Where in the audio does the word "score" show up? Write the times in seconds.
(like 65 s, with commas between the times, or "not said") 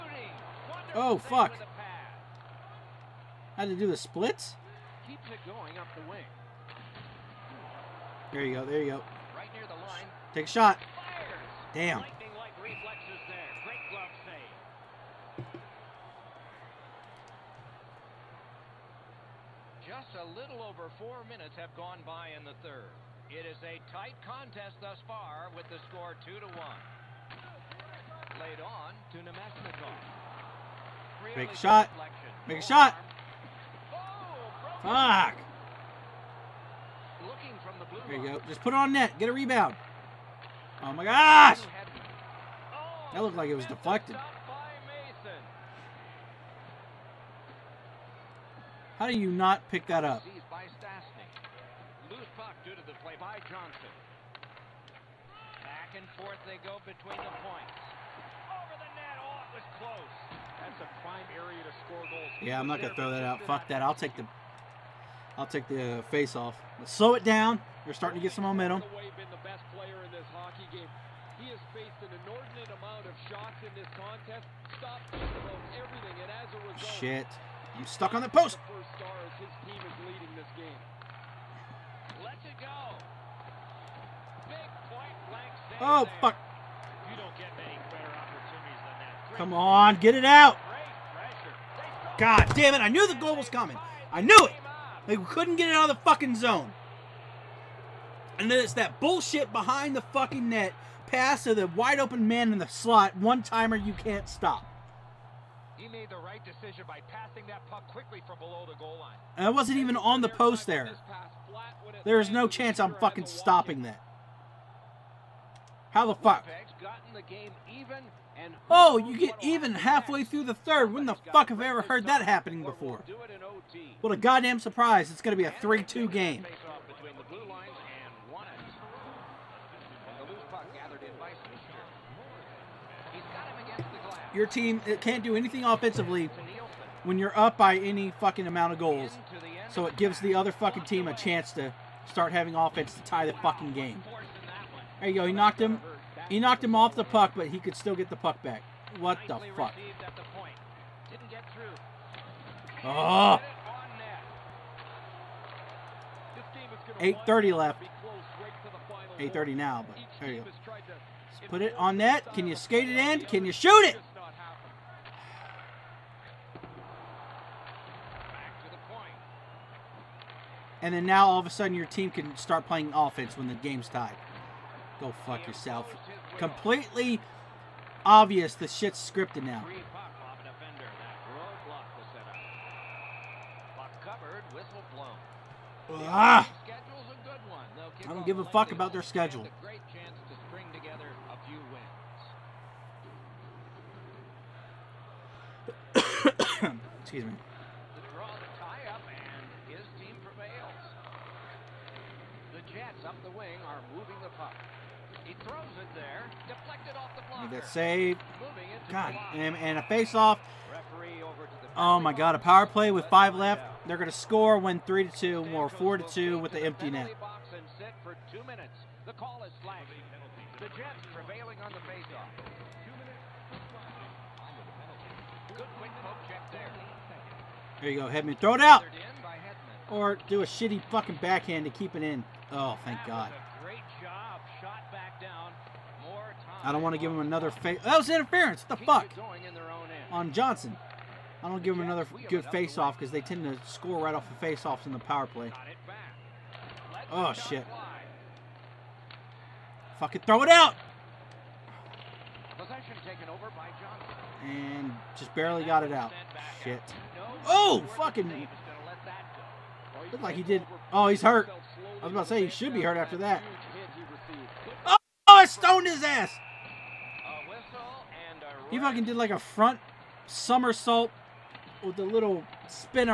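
25 s, 61 s, 214 s, 243 s.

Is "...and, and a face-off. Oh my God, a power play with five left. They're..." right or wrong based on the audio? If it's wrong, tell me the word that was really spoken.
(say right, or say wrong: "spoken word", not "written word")
right.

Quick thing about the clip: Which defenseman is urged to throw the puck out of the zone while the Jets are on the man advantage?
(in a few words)
Hedman.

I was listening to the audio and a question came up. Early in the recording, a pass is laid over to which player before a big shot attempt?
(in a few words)
Namestnikov.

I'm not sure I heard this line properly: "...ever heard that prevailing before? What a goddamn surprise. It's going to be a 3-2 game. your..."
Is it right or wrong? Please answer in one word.
wrong.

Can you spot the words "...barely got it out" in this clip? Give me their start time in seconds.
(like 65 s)
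255 s.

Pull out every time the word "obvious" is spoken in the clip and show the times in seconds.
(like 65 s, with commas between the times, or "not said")
178 s.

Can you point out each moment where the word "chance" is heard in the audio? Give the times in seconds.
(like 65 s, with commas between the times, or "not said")
112 s, 141 s.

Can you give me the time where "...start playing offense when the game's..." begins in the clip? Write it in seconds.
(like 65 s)
172 s.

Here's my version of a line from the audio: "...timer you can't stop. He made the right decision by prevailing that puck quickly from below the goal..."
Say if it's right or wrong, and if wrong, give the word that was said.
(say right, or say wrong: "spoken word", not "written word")
wrong: "passing", not "prevailing".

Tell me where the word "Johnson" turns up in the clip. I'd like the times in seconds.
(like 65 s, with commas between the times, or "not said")
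53 s, 240 s.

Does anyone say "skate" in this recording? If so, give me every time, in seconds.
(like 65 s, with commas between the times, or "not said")
162 s.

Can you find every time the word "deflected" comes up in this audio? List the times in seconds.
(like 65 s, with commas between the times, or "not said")
43 s, 206 s.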